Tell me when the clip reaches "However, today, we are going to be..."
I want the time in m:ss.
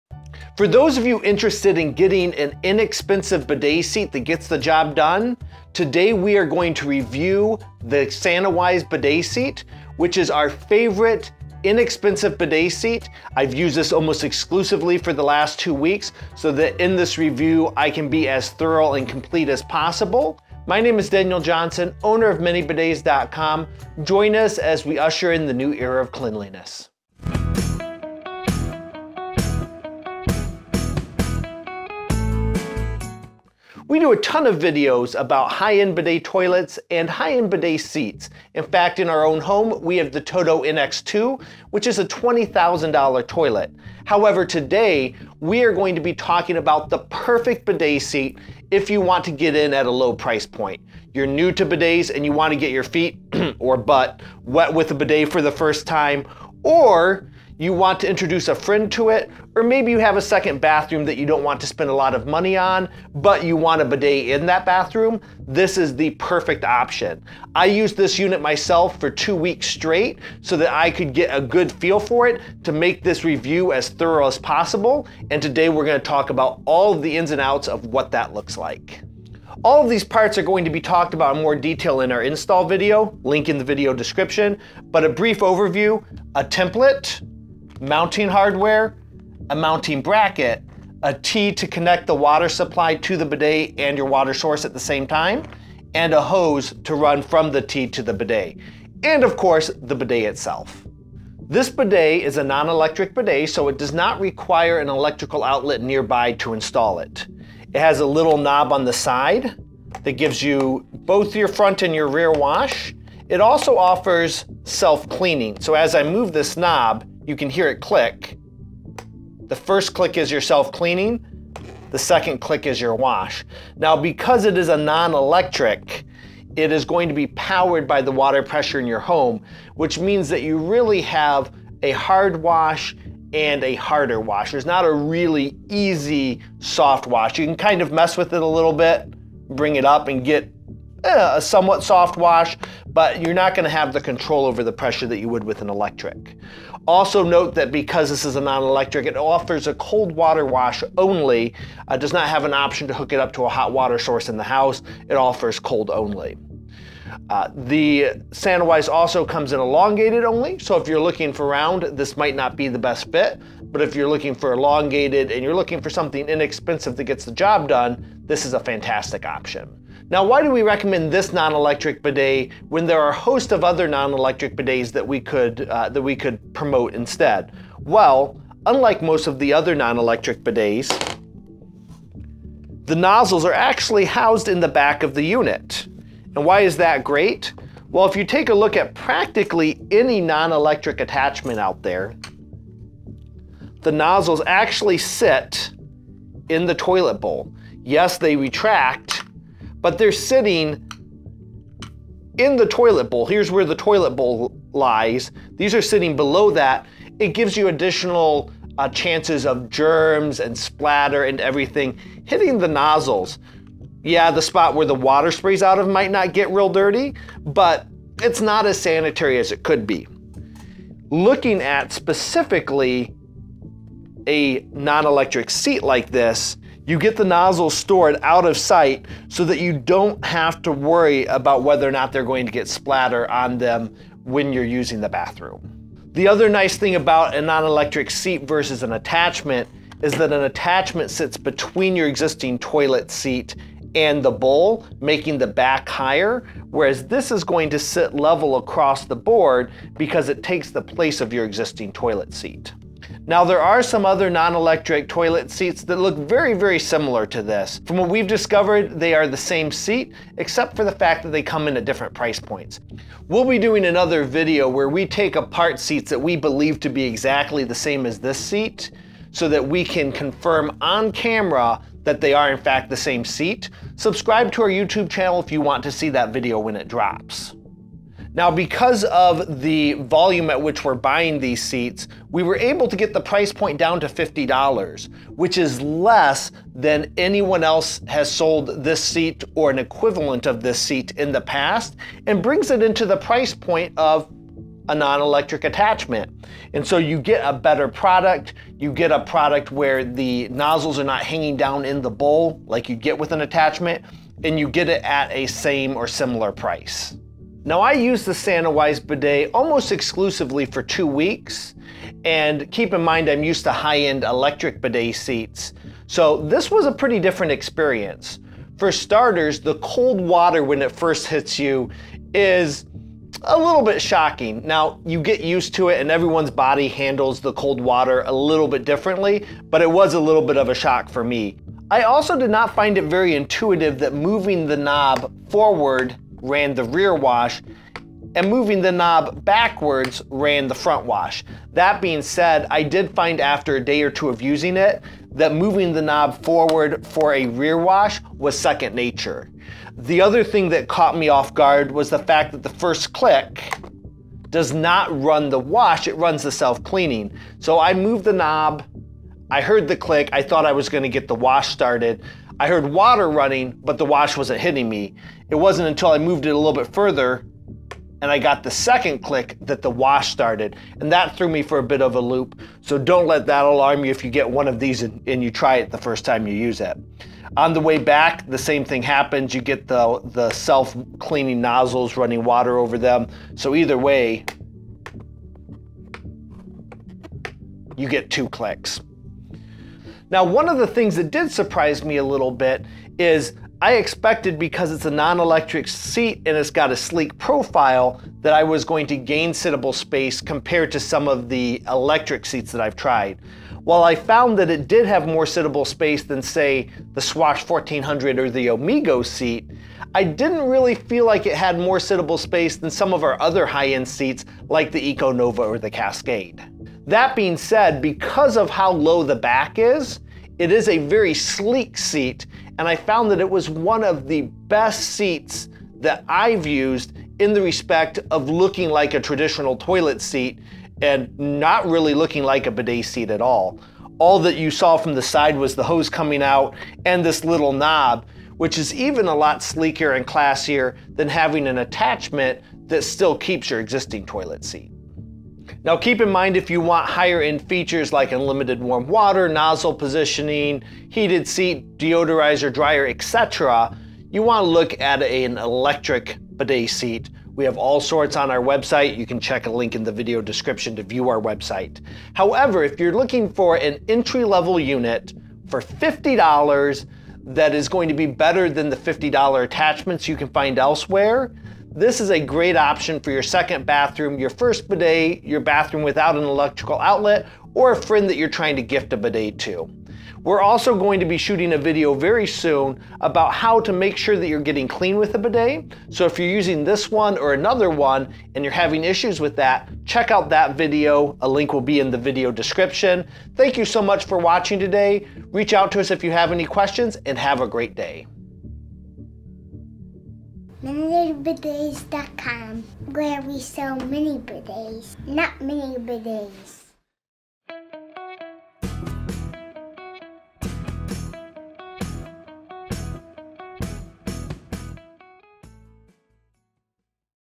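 0:44.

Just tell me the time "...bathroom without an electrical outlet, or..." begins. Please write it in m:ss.
7:55.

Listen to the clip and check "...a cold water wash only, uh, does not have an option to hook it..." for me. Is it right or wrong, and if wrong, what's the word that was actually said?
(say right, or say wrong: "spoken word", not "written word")
right.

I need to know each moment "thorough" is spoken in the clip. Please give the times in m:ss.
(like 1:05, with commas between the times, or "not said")
0:18, 1:13.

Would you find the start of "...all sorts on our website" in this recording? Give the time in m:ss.
7:37.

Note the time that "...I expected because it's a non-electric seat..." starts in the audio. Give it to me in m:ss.
6:33.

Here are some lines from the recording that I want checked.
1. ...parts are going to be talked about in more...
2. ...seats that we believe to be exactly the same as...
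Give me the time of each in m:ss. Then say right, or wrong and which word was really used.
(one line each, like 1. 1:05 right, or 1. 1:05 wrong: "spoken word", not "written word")
1. 1:20 right
2. 4:25 right.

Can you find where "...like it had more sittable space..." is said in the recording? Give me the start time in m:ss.
6:51.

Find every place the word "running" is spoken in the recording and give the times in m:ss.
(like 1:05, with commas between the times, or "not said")
6:03, 6:22.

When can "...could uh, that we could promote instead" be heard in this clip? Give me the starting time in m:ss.
2:55.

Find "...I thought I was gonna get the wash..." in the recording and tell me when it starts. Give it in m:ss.
6:00.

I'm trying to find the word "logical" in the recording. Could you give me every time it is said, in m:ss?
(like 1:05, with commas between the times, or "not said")
not said.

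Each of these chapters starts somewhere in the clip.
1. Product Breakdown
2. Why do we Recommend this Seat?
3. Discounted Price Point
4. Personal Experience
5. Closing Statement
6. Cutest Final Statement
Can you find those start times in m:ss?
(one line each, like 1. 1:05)
1. 0:33
2. 2:50
3. 4:38
4. 5:07
5. 7:25
6. 8:20.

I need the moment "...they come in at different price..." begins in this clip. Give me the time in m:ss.
4:21.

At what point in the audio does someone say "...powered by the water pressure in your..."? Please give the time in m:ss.
2:07.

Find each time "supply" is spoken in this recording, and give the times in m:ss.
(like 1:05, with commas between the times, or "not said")
1:32.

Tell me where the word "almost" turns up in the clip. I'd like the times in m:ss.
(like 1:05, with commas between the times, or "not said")
0:13, 5:09.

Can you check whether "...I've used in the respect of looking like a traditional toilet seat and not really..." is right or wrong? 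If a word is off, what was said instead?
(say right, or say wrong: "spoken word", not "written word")
right.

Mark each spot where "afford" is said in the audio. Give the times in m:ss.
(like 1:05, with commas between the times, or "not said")
not said.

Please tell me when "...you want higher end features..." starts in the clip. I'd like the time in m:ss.
7:26.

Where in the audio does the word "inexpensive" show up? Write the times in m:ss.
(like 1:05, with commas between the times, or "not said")
0:02, 0:11, 2:46.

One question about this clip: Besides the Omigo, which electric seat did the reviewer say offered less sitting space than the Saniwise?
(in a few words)
Swash 1400.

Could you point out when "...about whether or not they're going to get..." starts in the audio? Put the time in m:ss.
3:51.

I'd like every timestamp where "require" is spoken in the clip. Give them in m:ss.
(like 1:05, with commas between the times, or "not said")
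1:44.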